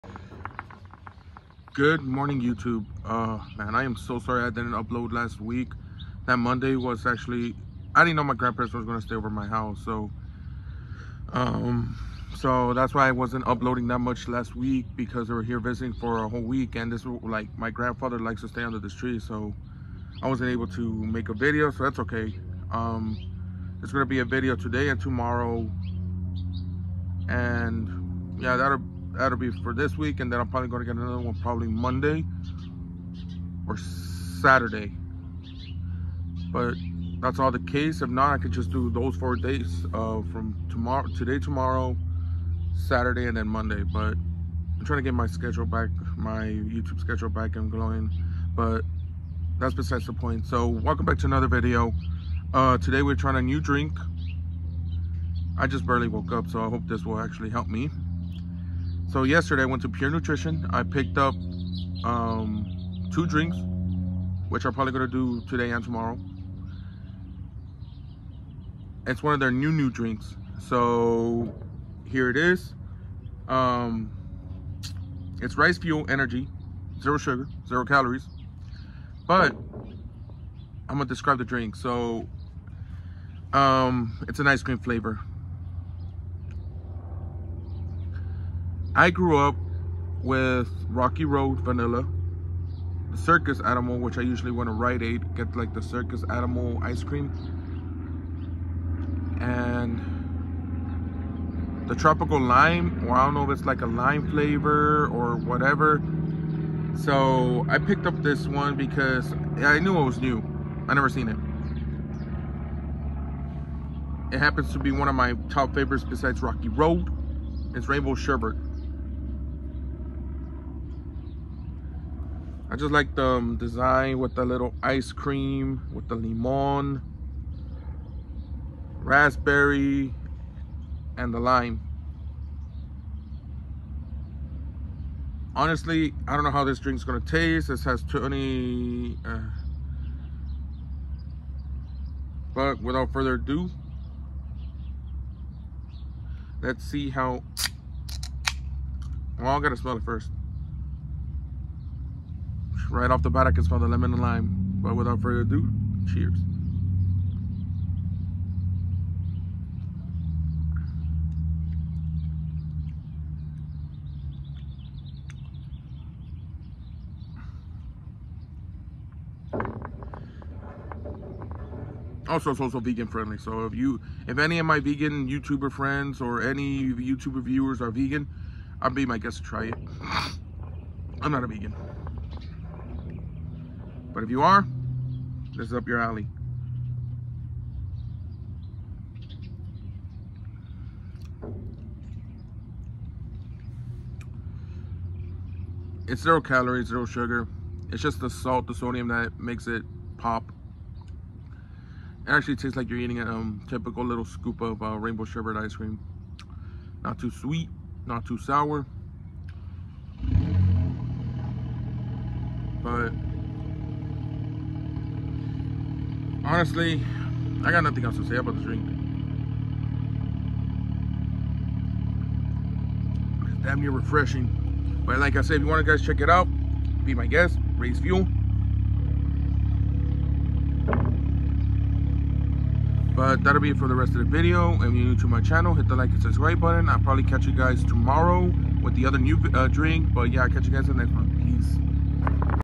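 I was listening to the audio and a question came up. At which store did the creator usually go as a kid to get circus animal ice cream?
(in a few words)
Rite Aid.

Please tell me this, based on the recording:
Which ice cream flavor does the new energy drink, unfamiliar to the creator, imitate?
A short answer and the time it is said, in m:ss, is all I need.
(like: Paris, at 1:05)
Rainbow Sherbert, at 1:57.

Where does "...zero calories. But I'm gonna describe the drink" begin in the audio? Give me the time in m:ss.
1:17.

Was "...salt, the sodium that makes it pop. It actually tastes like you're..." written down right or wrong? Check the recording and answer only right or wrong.
right.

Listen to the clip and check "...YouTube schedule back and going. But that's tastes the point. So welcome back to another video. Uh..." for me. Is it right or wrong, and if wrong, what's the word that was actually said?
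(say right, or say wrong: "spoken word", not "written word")
wrong: "besides", not "tastes".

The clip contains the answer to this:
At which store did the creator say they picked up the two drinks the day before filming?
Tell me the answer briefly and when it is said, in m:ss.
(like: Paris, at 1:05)
Pure Nutrition, at 0:59.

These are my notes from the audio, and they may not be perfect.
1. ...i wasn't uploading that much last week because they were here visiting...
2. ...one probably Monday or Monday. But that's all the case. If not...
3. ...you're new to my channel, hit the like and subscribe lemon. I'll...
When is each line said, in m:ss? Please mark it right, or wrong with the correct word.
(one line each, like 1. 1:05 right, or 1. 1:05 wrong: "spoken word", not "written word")
1. 0:13 right
2. 0:31 wrong: "Saturday", not "Monday"
3. 3:54 wrong: "button", not "lemon".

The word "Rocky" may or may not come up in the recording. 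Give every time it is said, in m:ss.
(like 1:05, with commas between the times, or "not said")
1:30, 1:56.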